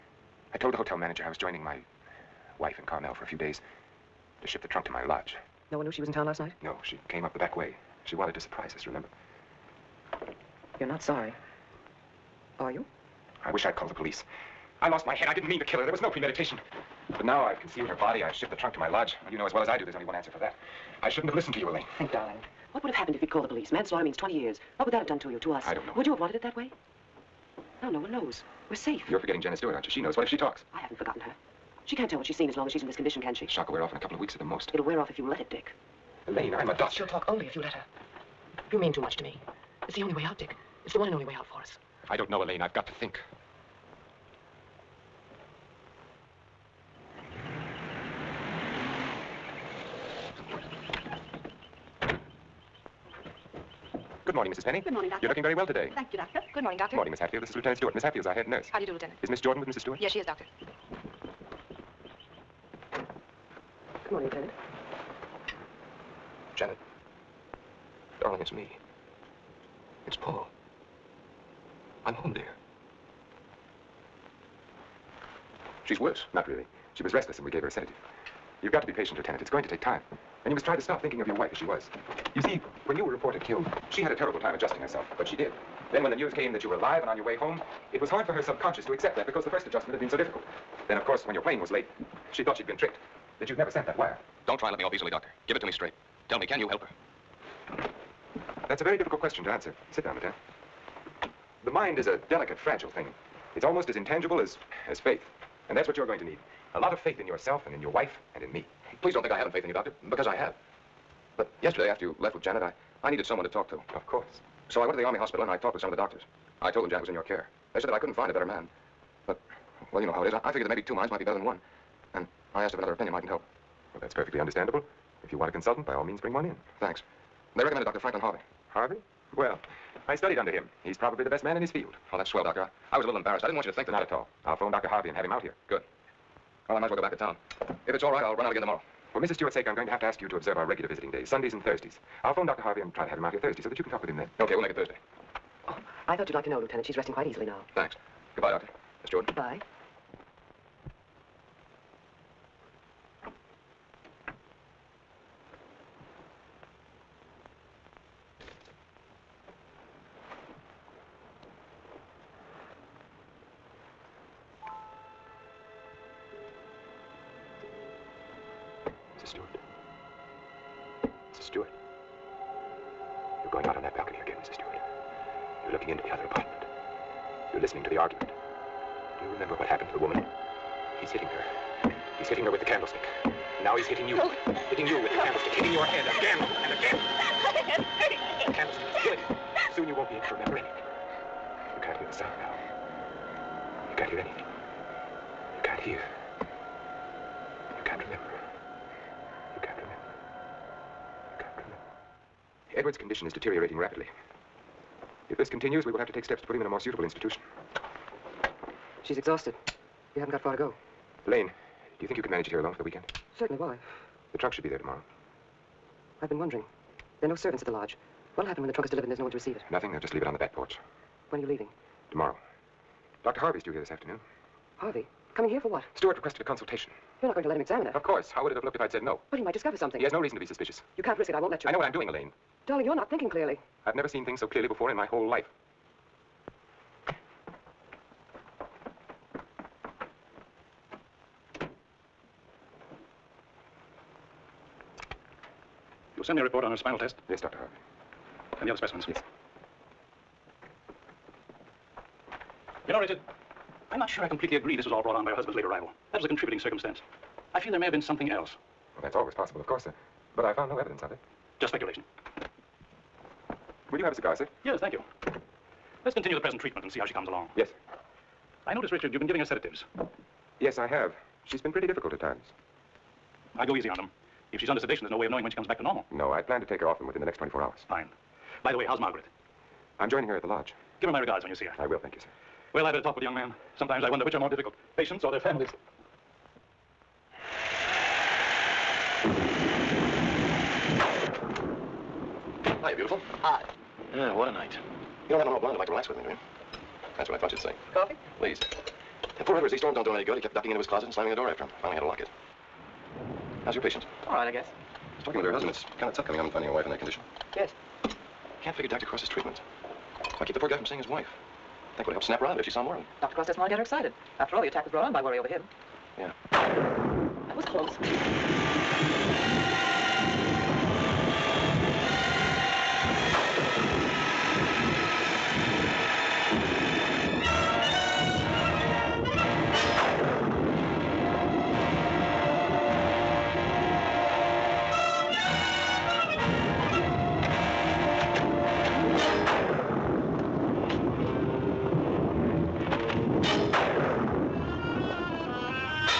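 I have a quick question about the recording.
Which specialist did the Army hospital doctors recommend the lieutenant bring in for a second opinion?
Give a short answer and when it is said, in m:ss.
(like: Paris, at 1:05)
Dr. Franklin Harvey, at 2:07.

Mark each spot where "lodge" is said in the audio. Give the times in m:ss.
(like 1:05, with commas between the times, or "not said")
0:05, 0:18, 3:37, 4:40.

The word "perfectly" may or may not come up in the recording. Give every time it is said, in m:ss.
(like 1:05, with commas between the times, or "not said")
2:04.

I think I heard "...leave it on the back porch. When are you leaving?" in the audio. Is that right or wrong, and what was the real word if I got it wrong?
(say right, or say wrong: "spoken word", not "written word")
right.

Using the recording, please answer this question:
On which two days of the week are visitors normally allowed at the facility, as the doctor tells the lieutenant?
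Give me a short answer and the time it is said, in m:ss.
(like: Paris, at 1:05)
Sundays and Thursdays, at 2:21.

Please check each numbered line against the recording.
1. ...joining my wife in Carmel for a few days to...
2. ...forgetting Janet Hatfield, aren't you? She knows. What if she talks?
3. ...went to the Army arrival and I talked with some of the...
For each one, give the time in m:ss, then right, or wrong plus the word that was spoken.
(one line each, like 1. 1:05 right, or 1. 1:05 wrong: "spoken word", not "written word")
1. 0:01 right
2. 0:29 wrong: "Stewart", not "Hatfield"
3. 1:54 wrong: "hospital", not "arrival".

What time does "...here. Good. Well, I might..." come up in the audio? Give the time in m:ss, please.
2:15.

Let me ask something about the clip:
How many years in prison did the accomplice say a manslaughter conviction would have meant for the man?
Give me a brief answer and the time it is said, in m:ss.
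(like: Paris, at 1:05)
20, at 0:24.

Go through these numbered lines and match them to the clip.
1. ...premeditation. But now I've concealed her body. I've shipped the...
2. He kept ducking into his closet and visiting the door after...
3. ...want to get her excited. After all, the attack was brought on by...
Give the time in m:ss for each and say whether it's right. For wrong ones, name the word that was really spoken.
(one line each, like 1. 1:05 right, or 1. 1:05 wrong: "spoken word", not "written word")
1. 0:16 right
2. 5:00 wrong: "slamming", not "visiting"
3. 5:13 right.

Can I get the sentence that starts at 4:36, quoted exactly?
No, I'd plan to take her off them within the next 24 hours.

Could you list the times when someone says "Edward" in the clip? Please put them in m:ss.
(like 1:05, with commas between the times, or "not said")
3:22, 4:59.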